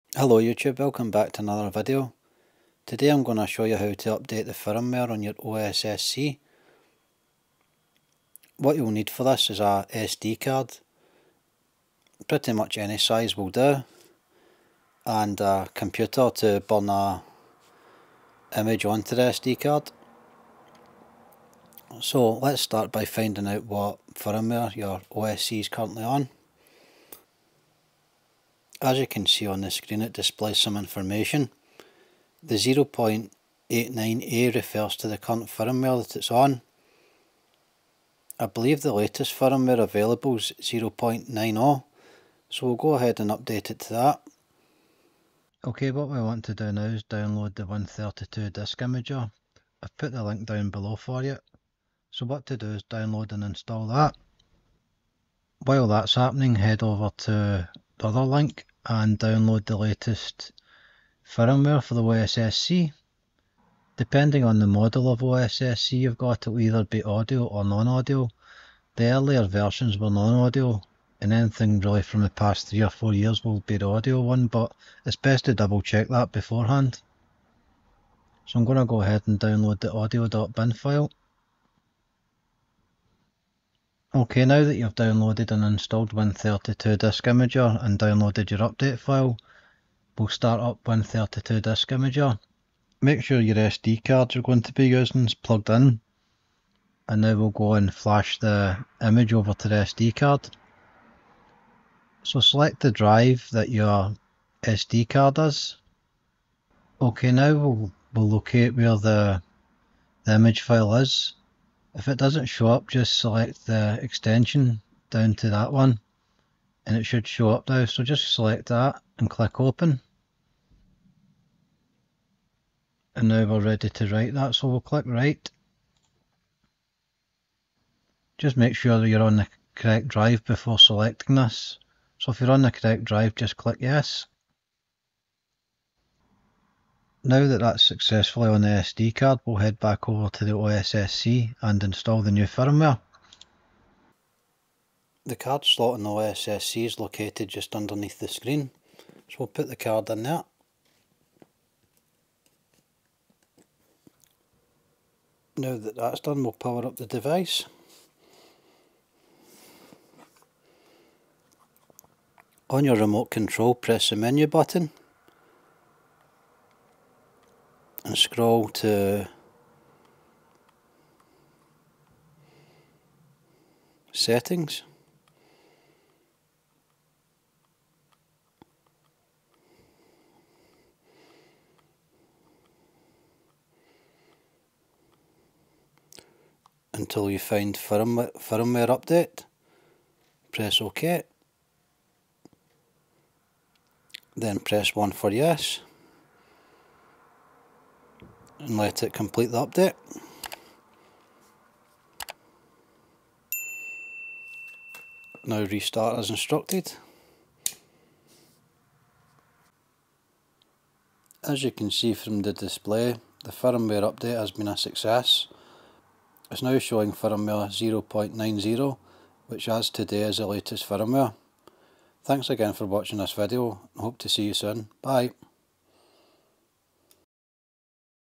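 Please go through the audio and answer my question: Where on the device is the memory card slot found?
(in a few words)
underneath the screen.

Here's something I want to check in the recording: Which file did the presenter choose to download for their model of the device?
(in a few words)
audio.bin.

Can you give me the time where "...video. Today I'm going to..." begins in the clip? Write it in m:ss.
0:01.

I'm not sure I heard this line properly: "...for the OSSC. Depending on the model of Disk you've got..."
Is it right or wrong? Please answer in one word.
wrong.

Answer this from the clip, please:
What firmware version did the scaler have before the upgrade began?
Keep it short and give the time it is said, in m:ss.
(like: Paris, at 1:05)
0.89A, at 0:32.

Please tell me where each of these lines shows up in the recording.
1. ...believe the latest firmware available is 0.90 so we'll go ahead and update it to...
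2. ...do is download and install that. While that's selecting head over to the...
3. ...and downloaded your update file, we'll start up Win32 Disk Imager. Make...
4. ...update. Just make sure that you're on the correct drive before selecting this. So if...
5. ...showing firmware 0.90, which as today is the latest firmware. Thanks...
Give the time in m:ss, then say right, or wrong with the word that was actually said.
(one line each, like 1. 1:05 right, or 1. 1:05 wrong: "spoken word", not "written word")
1. 0:38 right
2. 0:52 wrong: "happening", not "selecting"
3. 1:27 right
4. 2:05 wrong: "write", not "update"
5. 3:36 right.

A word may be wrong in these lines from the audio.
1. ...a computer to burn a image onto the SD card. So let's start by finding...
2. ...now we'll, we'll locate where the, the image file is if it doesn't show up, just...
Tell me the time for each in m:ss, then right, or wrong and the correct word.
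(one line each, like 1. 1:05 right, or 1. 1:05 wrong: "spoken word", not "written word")
1. 0:15 right
2. 1:47 right.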